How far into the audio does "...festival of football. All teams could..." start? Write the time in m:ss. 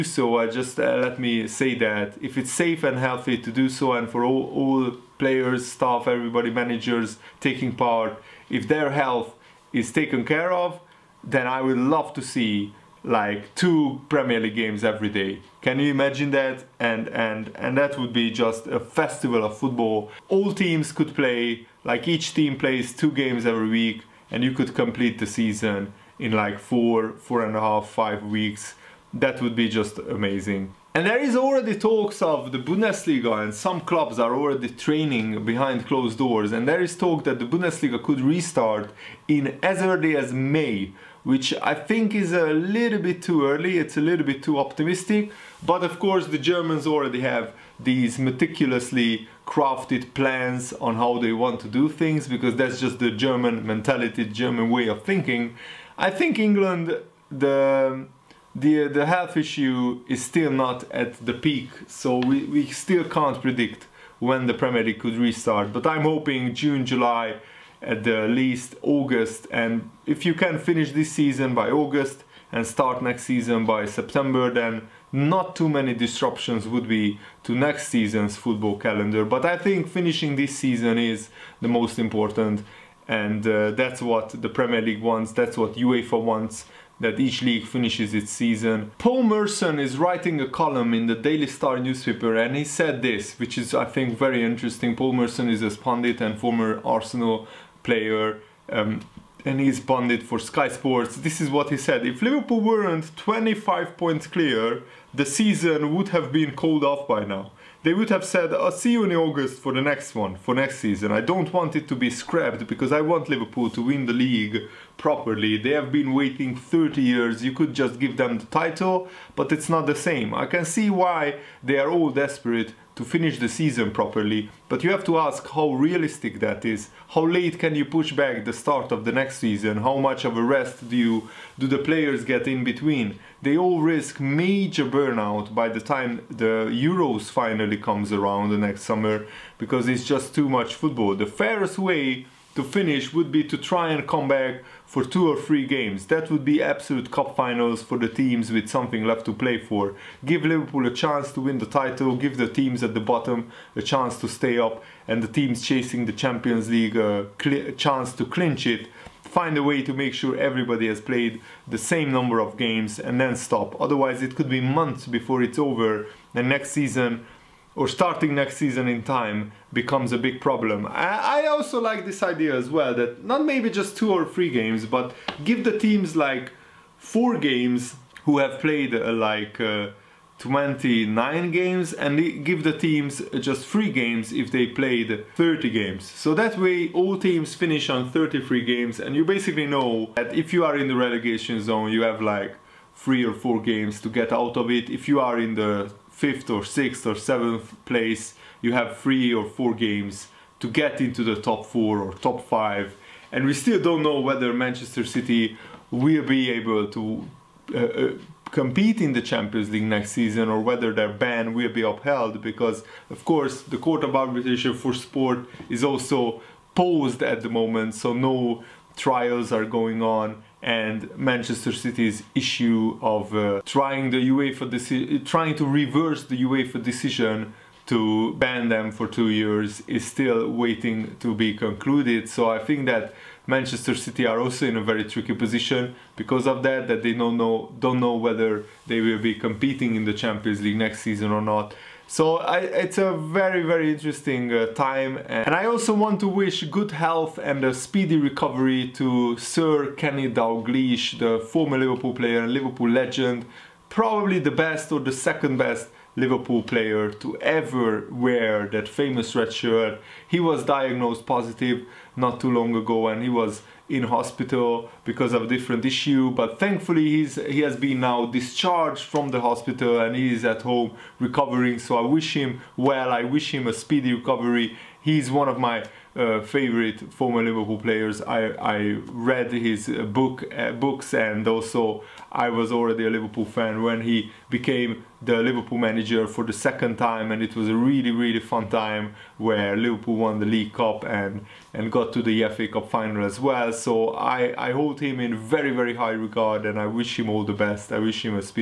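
0:18.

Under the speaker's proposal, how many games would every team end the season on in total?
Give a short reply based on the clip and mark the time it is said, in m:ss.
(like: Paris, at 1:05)
33, at 3:08.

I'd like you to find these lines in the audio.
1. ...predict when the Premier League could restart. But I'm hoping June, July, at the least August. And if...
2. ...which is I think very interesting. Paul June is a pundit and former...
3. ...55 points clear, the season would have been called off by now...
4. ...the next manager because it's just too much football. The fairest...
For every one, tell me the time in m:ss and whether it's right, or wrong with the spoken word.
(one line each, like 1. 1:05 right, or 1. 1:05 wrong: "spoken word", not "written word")
1. 1:03 right
2. 1:33 wrong: "Merson", not "June"
3. 1:43 wrong: "25", not "55"
4. 2:18 wrong: "summer", not "manager".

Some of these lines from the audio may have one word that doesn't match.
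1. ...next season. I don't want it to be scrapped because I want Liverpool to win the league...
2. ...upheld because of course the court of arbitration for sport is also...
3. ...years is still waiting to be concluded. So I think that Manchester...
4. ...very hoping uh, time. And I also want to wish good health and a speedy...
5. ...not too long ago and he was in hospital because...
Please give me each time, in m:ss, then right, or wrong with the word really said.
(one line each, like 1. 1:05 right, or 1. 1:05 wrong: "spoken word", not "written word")
1. 1:50 right
2. 3:31 right
3. 3:49 right
4. 4:03 wrong: "interesting", not "hoping"
5. 4:22 right.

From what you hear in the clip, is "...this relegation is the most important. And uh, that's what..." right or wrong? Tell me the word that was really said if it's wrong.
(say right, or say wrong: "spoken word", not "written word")
wrong: "season", not "relegation".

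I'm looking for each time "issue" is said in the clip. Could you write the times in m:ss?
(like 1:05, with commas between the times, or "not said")
0:59, 3:42, 4:25.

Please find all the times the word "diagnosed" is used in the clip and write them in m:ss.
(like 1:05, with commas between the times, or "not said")
4:20.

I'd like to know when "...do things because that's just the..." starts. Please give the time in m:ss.
0:51.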